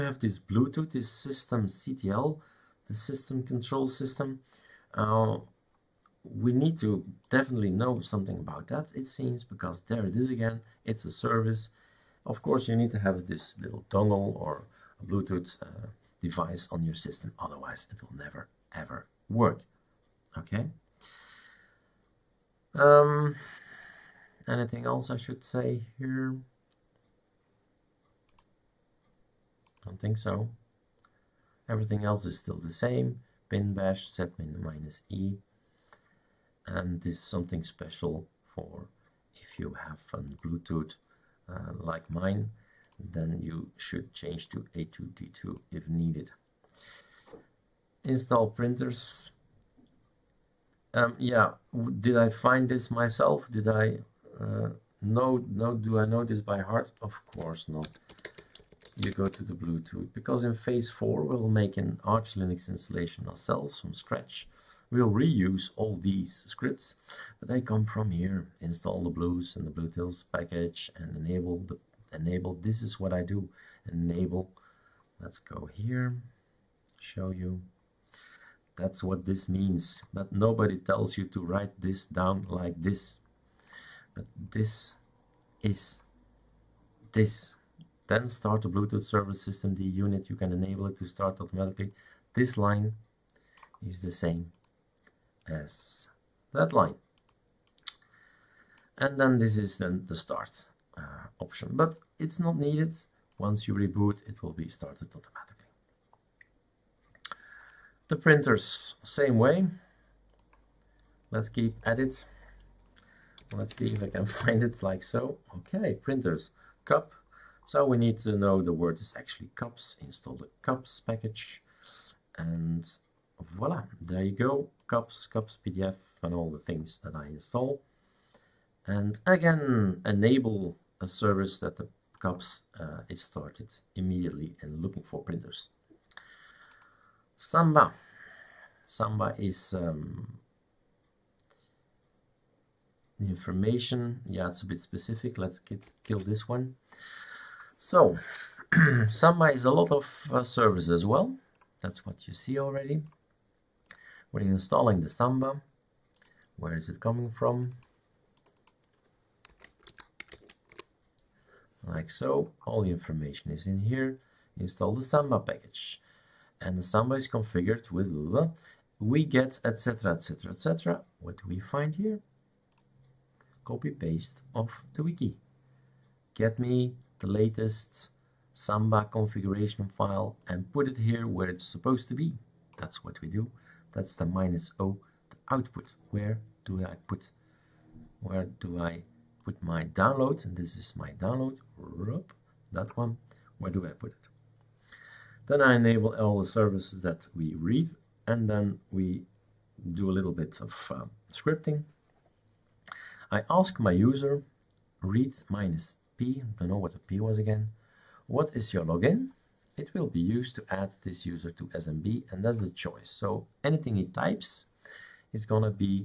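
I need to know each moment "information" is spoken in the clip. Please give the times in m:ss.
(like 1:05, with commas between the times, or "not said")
2:23, 2:42.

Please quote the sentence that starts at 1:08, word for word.
Install the bluez and the bluez-utils package and enable the enable.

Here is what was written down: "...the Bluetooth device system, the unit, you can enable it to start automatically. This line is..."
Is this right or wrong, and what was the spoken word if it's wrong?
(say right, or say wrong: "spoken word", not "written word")
wrong: "service", not "device".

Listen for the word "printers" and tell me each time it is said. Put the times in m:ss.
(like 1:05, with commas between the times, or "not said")
0:48, 1:48, 1:55, 2:15.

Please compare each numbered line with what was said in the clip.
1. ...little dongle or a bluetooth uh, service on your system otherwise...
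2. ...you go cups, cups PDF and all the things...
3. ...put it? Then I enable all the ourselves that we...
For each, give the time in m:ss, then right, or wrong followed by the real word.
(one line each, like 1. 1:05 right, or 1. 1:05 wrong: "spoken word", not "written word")
1. 0:13 wrong: "device", not "service"
2. 2:04 right
3. 3:13 wrong: "services", not "ourselves".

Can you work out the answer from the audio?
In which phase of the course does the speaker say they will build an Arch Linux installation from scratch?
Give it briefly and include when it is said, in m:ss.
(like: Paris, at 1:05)
Phase 4, at 1:00.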